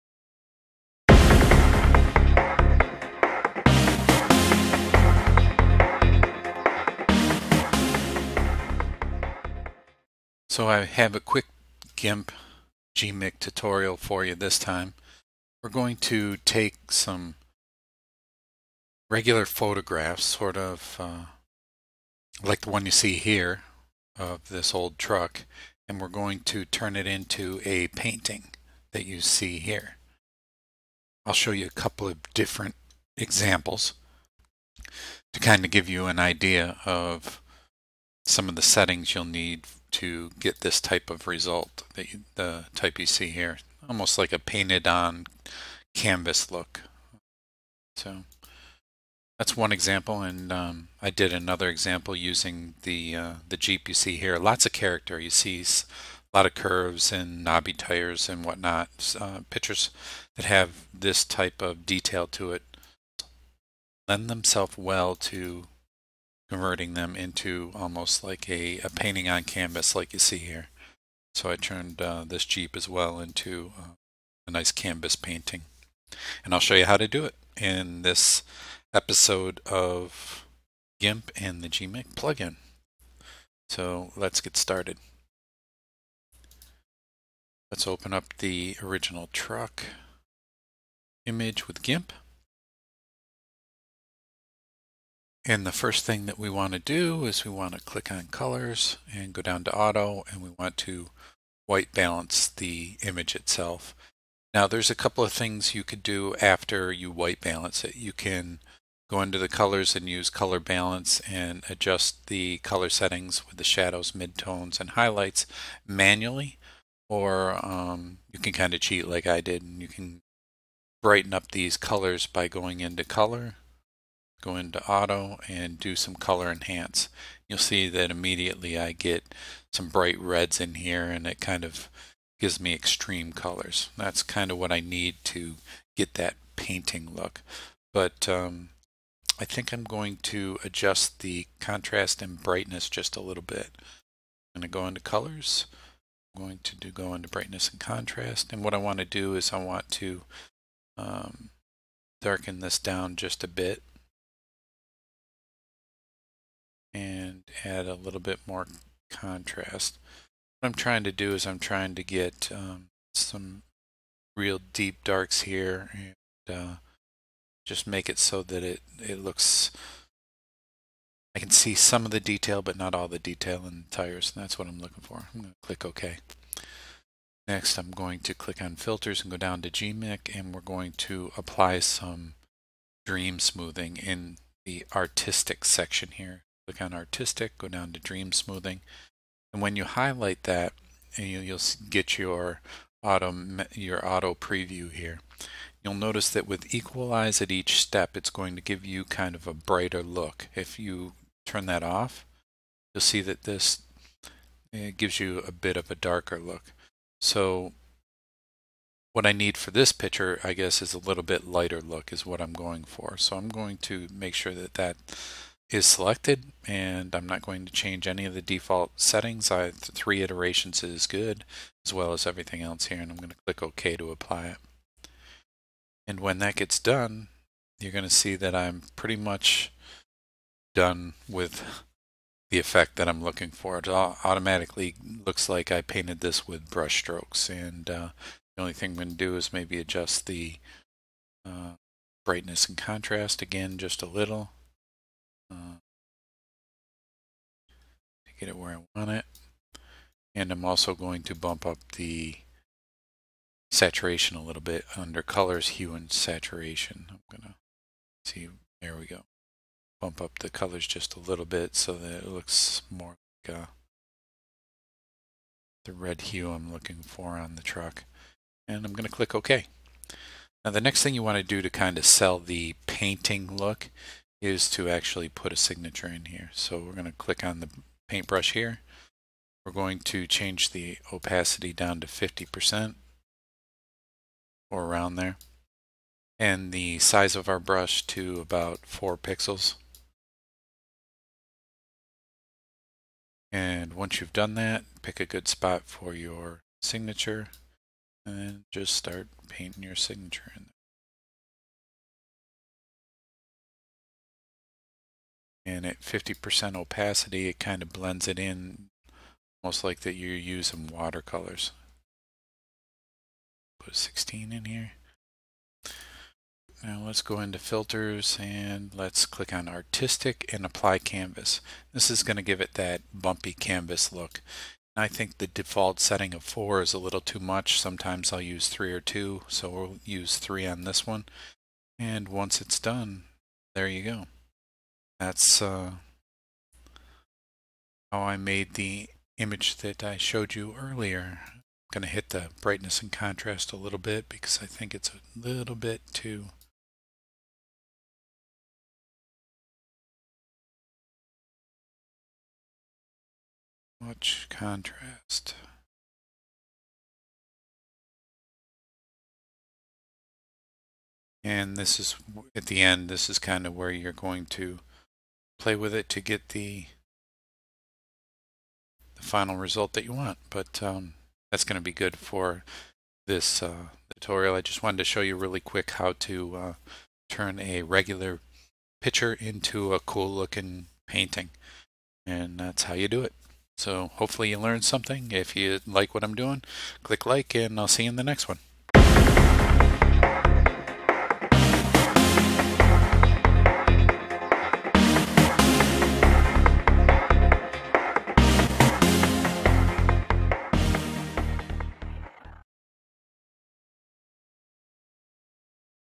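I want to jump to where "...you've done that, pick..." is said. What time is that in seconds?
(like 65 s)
294 s.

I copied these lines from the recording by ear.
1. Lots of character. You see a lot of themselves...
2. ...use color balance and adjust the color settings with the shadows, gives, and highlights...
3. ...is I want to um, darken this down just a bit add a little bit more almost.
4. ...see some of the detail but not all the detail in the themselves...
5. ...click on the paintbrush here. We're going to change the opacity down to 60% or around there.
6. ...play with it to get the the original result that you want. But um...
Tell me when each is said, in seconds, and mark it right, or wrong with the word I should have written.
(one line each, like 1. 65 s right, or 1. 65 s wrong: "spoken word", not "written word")
1. 54 s wrong: "curves", not "themselves"
2. 110 s wrong: "midtones", not "gives"
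3. 149 s wrong: "contrast", not "almost"
4. 171 s wrong: "tires", not "themselves"
5. 277 s wrong: "50", not "60"
6. 365 s wrong: "final", not "original".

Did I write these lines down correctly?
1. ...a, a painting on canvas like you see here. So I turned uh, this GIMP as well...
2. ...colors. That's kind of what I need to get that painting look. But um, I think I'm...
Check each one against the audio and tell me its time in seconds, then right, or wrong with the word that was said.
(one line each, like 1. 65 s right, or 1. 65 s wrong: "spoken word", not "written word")
1. 68 s wrong: "Jeep", not "GIMP"
2. 133 s right.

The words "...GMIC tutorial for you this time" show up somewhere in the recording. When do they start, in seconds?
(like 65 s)
12 s.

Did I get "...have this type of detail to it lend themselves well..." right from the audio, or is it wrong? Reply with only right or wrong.
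right.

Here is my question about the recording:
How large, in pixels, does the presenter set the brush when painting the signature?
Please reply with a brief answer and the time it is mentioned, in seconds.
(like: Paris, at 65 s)
4 pixels, at 288 s.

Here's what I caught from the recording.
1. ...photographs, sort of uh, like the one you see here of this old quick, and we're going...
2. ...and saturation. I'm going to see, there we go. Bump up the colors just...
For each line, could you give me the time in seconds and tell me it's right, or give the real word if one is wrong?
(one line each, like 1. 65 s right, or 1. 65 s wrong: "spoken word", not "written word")
1. 19 s wrong: "truck", not "quick"
2. 255 s right.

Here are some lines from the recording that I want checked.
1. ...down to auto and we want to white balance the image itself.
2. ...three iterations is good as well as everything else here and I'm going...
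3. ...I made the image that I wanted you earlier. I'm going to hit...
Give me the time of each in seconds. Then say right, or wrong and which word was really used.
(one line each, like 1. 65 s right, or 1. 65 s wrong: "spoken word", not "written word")
1. 99 s right
2. 219 s right
3. 338 s wrong: "showed", not "wanted".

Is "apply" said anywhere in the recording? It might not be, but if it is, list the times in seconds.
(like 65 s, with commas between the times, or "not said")
181 s, 224 s, 320 s.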